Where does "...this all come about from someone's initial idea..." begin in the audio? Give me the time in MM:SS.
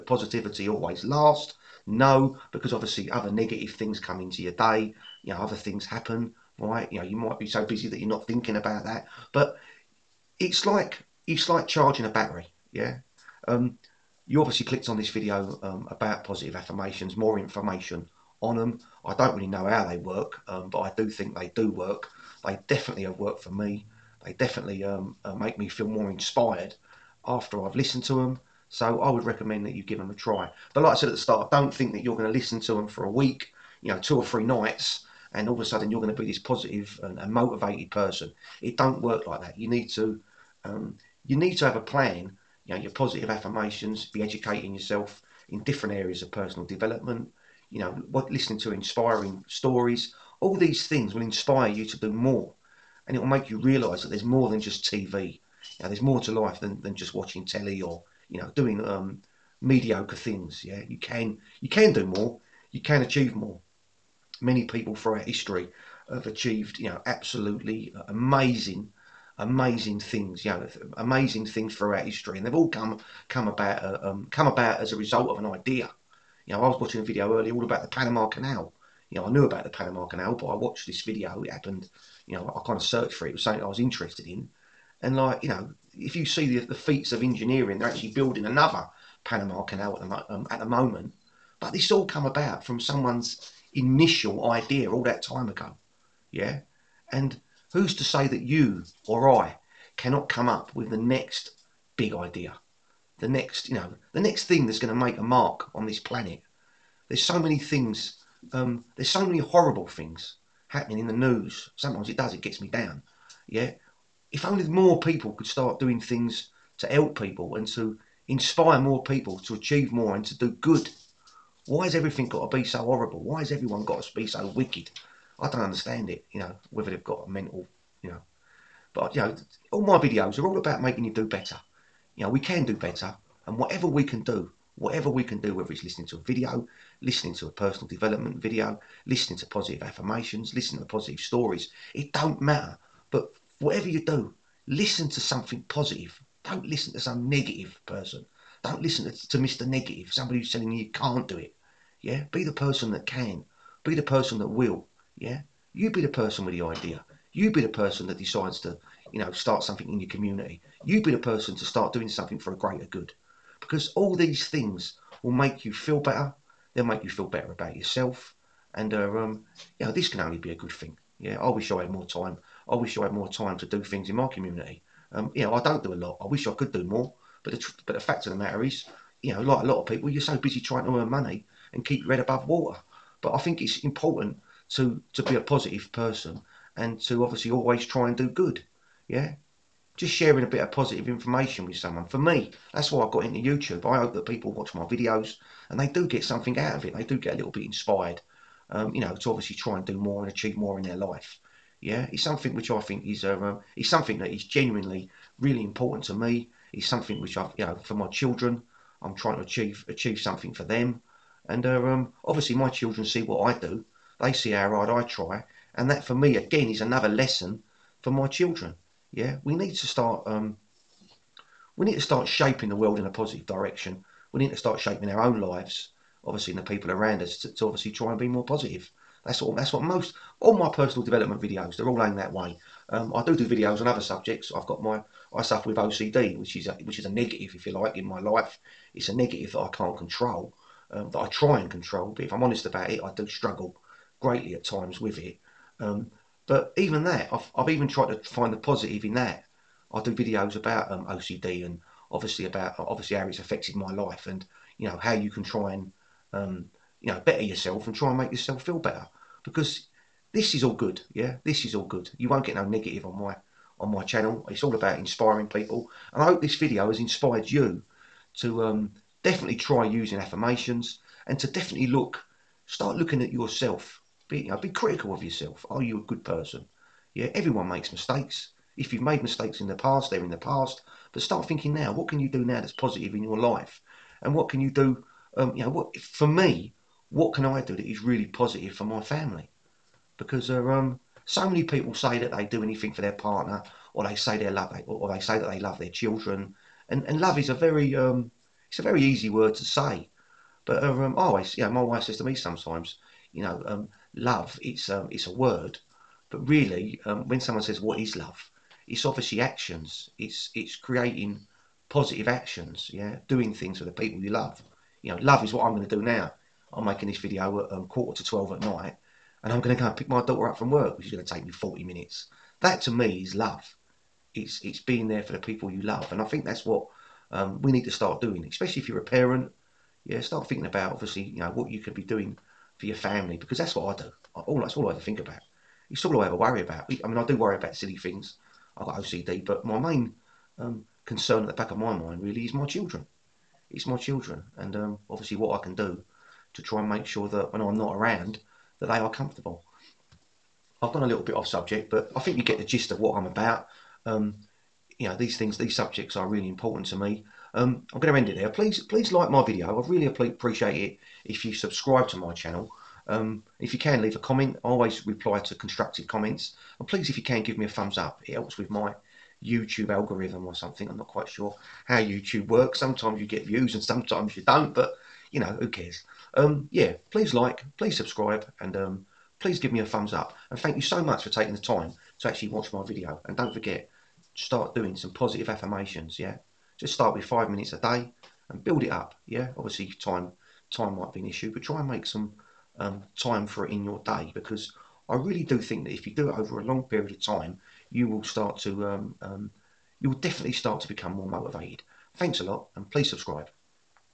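01:31.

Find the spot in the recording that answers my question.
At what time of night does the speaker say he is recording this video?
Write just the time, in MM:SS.
05:17.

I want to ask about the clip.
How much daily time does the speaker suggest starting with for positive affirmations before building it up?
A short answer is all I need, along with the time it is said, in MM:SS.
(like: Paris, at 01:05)
5 minutes, at 06:27.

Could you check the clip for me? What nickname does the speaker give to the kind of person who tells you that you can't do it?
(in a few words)
Mr. Negative.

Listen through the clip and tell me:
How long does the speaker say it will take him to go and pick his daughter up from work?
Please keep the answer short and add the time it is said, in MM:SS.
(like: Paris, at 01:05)
40 minutes, at 05:21.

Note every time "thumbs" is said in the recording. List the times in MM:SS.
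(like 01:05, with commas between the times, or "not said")
06:07, 06:19.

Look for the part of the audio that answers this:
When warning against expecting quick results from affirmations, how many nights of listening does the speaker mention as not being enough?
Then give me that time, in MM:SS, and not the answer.
00:33.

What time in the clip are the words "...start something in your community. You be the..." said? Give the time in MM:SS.
02:39.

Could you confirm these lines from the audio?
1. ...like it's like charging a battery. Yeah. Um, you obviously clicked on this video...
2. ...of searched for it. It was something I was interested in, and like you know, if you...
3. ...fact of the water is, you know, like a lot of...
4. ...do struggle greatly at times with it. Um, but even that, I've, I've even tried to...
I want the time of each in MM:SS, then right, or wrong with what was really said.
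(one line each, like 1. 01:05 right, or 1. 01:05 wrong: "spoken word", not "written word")
1. 00:10 right
2. 01:22 right
3. 02:57 wrong: "matter", not "water"
4. 04:03 right.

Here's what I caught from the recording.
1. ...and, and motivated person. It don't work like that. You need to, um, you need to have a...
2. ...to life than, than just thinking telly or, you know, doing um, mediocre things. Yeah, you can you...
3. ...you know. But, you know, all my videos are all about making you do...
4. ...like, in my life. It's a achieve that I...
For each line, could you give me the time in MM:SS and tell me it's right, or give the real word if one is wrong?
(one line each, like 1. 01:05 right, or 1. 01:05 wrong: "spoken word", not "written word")
1. 00:37 right
2. 00:56 wrong: "watching", not "thinking"
3. 02:08 right
4. 03:57 wrong: "negative", not "achieve".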